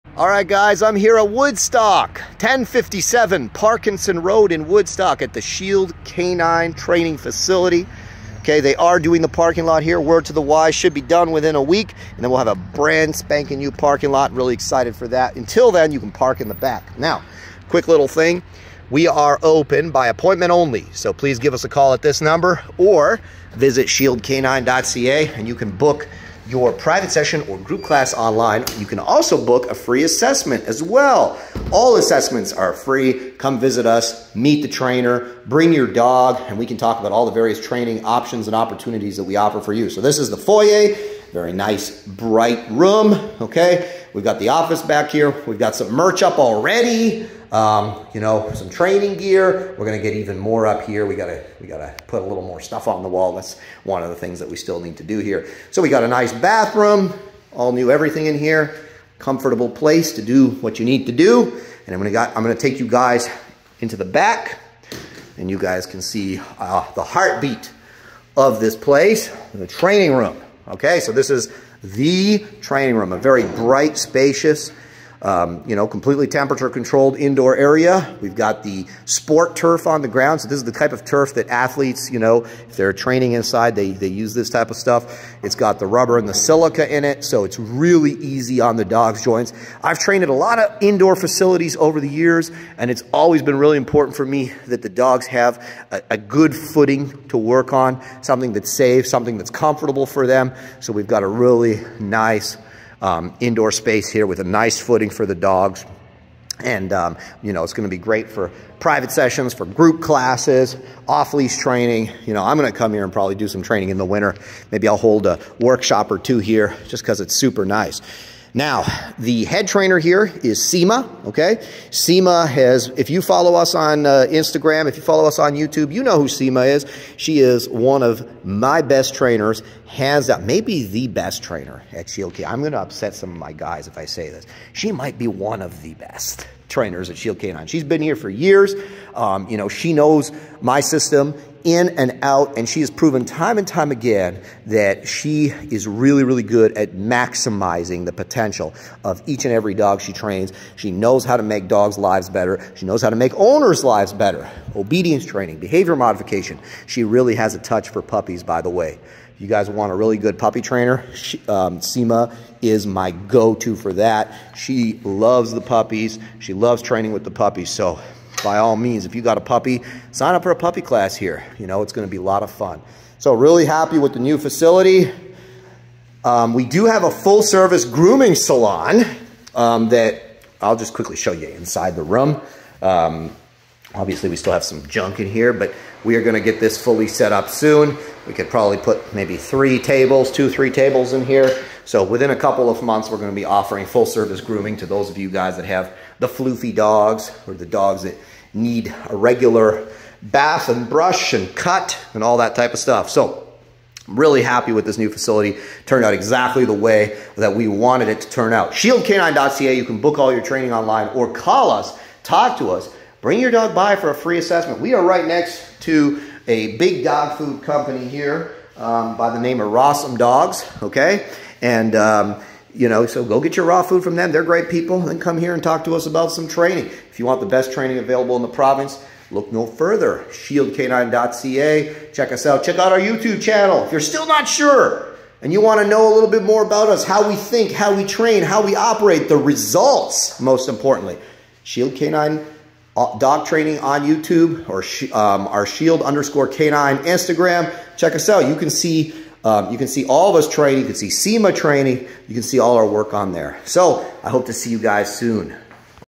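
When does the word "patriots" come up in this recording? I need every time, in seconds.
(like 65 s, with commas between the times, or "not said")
not said.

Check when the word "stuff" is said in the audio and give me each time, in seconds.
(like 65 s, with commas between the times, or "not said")
52 s, 84 s, 202 s.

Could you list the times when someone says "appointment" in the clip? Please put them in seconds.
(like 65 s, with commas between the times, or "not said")
20 s.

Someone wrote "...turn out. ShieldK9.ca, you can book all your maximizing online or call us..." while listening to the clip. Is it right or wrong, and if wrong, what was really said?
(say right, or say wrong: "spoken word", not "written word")
wrong: "training", not "maximizing".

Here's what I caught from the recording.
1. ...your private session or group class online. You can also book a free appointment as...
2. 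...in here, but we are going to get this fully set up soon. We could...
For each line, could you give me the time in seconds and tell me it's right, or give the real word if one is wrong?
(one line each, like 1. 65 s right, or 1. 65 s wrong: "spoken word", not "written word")
1. 26 s wrong: "assessment", not "appointment"
2. 185 s right.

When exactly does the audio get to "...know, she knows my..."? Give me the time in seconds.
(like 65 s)
139 s.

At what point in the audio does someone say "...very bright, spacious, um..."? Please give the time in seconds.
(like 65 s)
73 s.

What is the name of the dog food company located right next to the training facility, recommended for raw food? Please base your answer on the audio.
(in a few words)
Rossum Dogs.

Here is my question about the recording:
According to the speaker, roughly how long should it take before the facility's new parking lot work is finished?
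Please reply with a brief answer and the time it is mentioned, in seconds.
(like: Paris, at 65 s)
a week, at 11 s.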